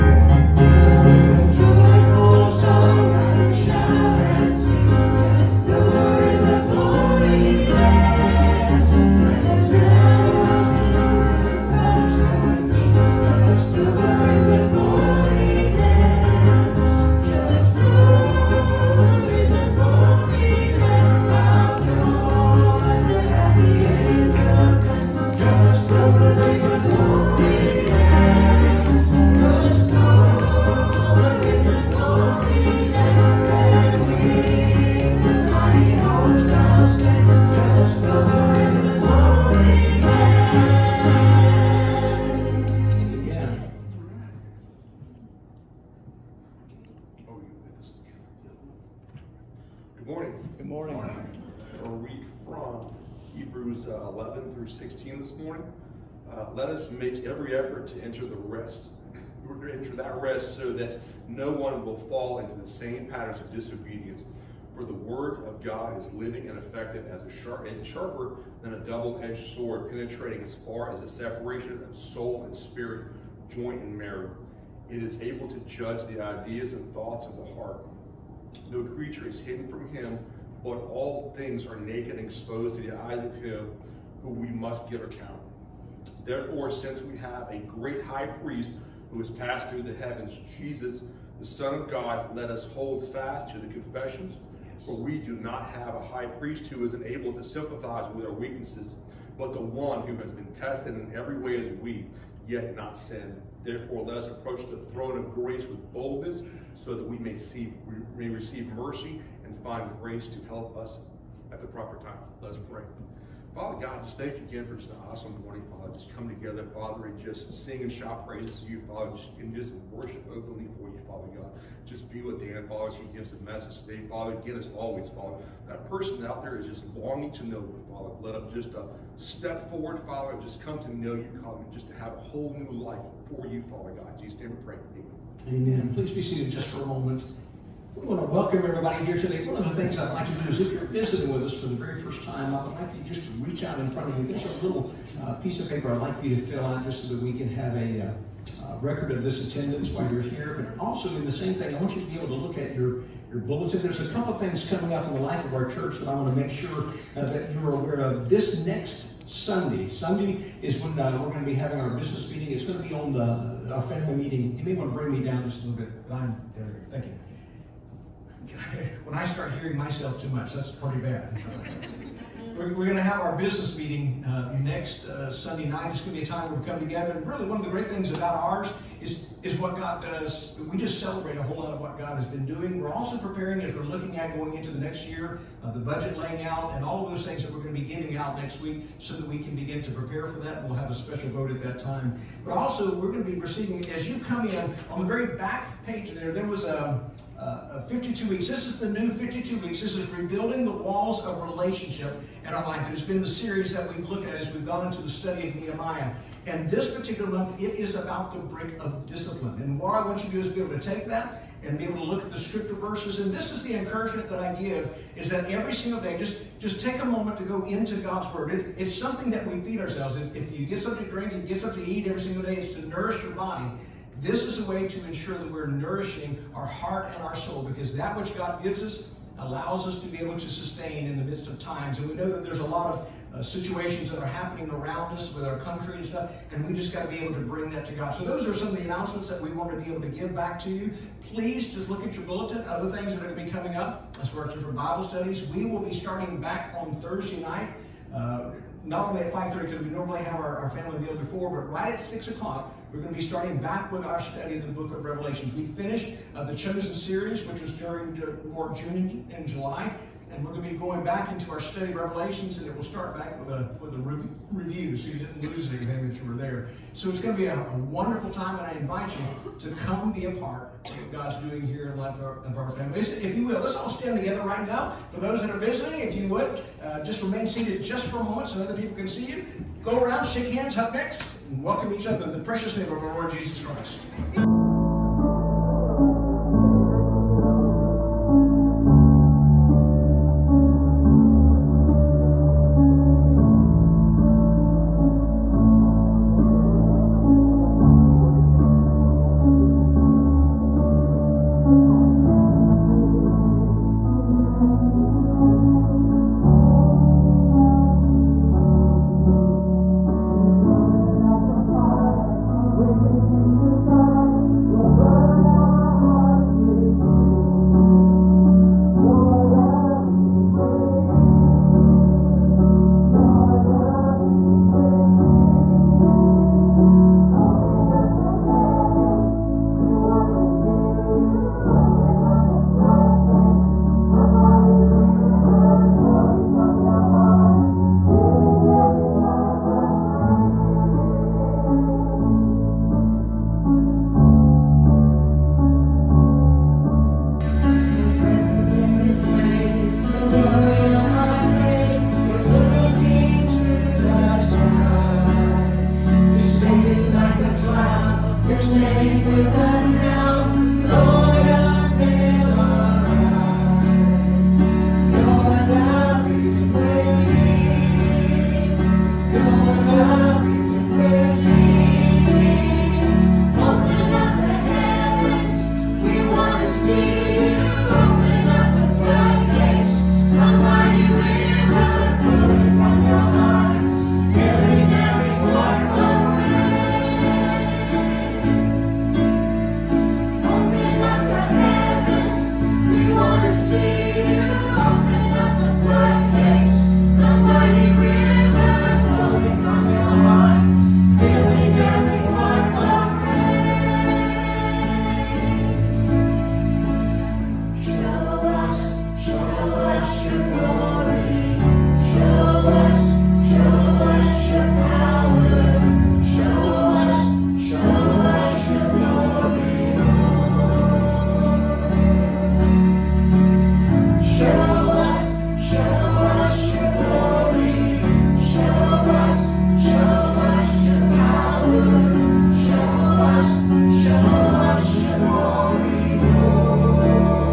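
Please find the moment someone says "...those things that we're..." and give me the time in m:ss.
3:07.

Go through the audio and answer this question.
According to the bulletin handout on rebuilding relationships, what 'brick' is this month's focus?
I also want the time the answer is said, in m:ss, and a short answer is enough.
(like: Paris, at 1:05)
Discipline, at 3:28.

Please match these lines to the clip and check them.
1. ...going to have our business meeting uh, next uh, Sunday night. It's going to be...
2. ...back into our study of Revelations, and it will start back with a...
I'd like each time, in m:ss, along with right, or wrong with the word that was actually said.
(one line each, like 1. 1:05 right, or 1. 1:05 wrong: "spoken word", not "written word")
1. 2:52 right
2. 4:21 right.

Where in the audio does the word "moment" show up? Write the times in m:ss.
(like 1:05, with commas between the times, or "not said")
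2:16, 3:37, 4:38.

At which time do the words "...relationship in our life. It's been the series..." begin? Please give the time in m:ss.
3:21.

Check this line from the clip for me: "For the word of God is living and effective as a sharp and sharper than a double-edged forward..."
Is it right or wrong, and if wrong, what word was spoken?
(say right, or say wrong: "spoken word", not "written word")
wrong: "sword", not "forward".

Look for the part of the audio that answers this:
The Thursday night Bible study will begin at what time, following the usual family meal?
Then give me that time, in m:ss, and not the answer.
4:12.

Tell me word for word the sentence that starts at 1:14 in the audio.
It is able to judge the ideas and thoughts of the heart.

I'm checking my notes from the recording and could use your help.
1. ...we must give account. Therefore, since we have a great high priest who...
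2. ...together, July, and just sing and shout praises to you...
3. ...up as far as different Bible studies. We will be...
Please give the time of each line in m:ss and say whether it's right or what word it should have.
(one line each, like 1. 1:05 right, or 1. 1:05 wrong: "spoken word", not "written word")
1. 1:24 right
2. 1:56 wrong: "Father", not "July"
3. 4:03 right.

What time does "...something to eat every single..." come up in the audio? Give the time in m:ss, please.
3:41.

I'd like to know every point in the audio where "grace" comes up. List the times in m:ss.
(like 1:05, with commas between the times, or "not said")
1:45, 1:50.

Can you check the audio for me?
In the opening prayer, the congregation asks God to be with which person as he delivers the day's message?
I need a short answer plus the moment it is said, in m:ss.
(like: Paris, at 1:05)
Dan, at 2:02.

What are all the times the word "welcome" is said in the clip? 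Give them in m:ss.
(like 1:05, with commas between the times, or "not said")
2:18, 4:41.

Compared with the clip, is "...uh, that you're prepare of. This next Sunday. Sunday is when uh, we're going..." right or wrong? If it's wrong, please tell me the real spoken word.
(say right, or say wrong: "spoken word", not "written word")
wrong: "aware", not "prepare".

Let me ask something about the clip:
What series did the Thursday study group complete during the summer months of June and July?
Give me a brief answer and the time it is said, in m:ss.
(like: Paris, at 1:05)
The Chosen, at 4:16.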